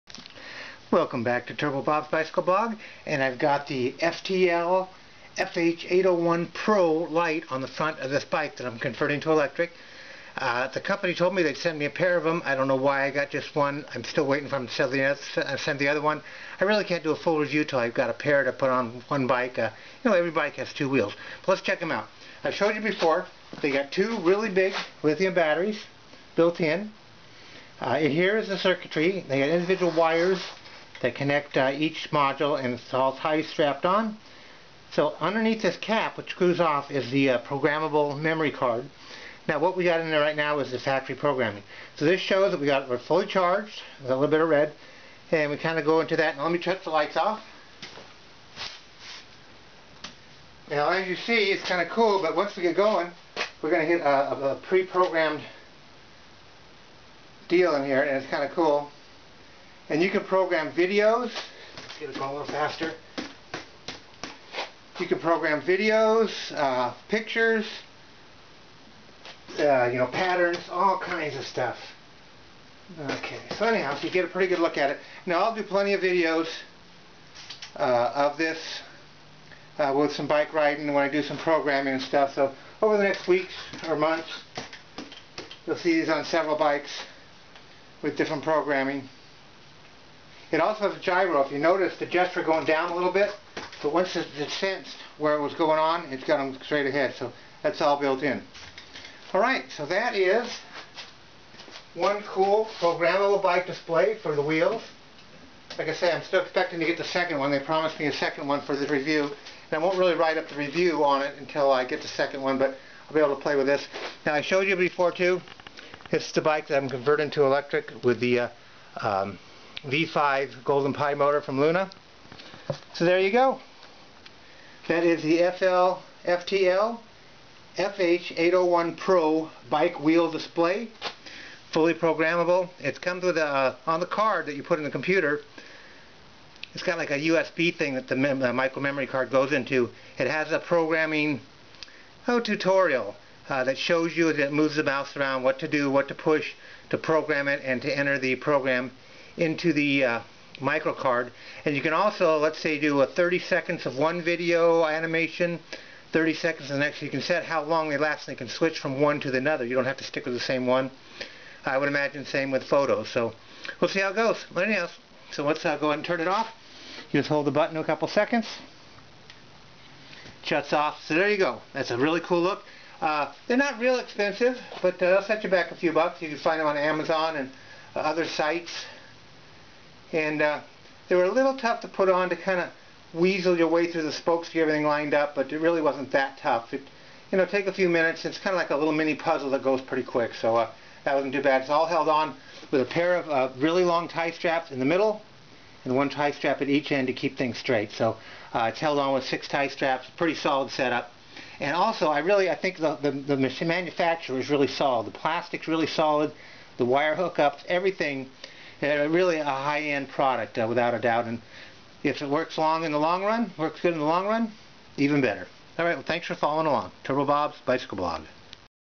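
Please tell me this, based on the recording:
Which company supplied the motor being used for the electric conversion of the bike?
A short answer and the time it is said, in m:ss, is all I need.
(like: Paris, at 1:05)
Luna, at 2:01.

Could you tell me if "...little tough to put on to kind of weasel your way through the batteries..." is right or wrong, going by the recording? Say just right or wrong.
wrong.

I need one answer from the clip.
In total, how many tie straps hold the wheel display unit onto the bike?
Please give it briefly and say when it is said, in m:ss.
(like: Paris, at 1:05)
6, at 3:19.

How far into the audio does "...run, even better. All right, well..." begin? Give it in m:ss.
3:34.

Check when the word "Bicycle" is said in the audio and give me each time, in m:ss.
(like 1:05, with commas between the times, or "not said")
0:02, 3:37.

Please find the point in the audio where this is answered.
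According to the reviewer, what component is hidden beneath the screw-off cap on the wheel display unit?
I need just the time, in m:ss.
0:37.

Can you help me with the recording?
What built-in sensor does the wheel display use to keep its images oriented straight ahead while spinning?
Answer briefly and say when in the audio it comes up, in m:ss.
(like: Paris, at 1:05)
gyro, at 1:30.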